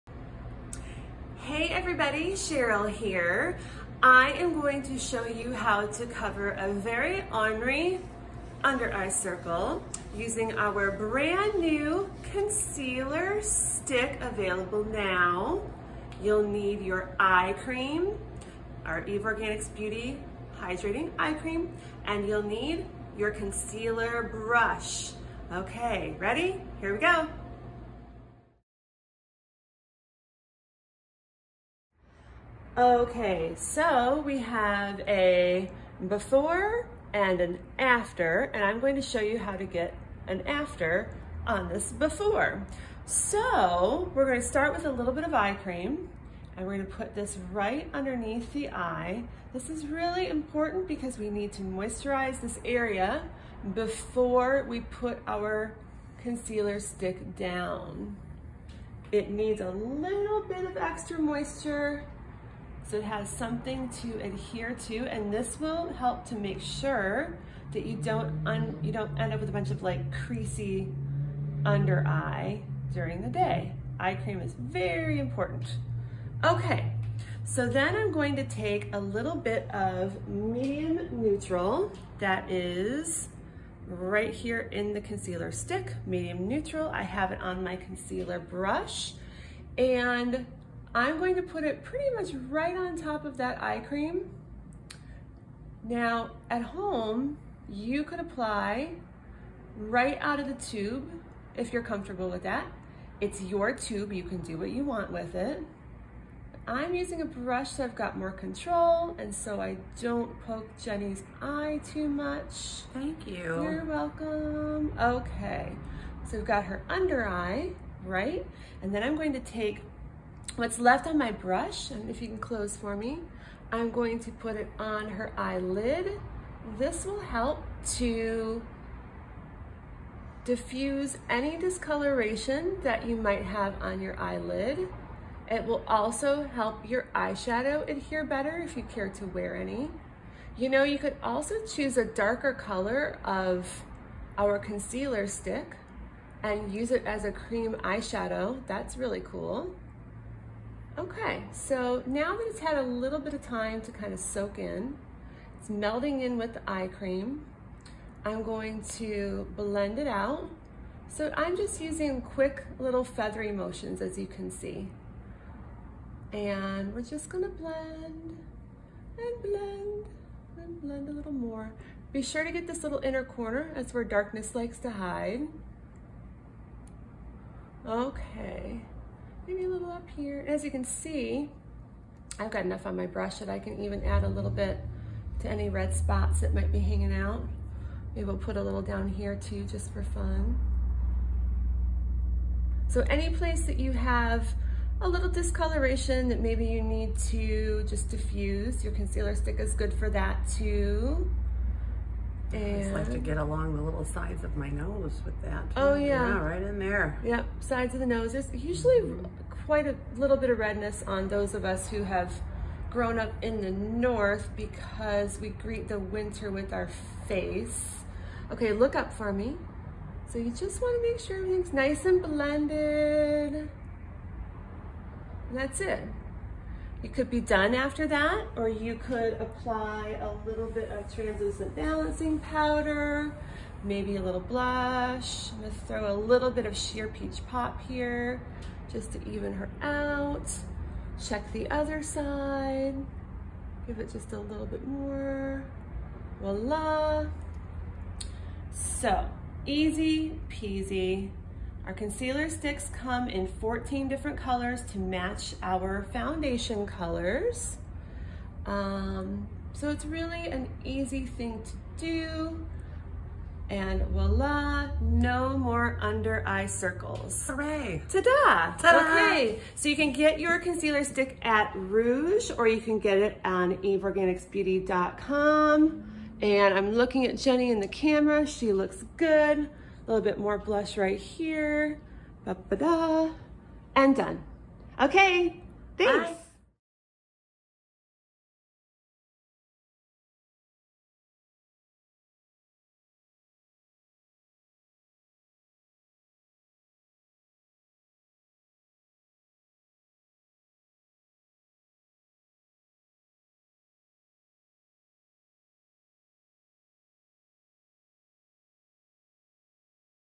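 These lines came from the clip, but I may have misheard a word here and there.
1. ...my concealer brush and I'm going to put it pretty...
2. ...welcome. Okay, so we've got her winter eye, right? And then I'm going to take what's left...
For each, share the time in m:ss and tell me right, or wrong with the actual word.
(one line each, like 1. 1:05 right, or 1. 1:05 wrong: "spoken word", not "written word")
1. 1:27 right
2. 1:53 wrong: "under", not "winter".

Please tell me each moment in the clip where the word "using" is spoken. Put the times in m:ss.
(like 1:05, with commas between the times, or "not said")
0:10, 1:46, 2:41.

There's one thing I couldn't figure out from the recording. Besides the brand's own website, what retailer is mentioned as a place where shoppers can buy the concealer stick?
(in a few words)
Rouge.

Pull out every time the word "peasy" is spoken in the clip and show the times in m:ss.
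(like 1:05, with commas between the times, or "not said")
4:10.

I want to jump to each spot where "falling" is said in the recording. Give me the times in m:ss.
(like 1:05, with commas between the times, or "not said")
not said.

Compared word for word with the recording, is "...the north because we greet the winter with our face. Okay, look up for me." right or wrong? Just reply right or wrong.
right.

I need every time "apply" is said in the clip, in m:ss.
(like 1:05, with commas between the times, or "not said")
1:38, 3:49.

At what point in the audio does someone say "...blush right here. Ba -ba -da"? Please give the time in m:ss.
4:40.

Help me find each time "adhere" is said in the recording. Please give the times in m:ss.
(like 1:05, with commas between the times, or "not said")
1:04, 2:17.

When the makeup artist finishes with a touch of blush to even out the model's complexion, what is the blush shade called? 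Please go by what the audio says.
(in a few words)
Sheer peach pop.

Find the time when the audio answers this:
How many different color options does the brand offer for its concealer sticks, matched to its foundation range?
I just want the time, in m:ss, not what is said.
4:13.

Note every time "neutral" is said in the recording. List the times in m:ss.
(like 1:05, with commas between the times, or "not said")
1:21, 1:26.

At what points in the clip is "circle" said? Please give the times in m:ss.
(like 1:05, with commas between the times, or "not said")
0:09, 4:26.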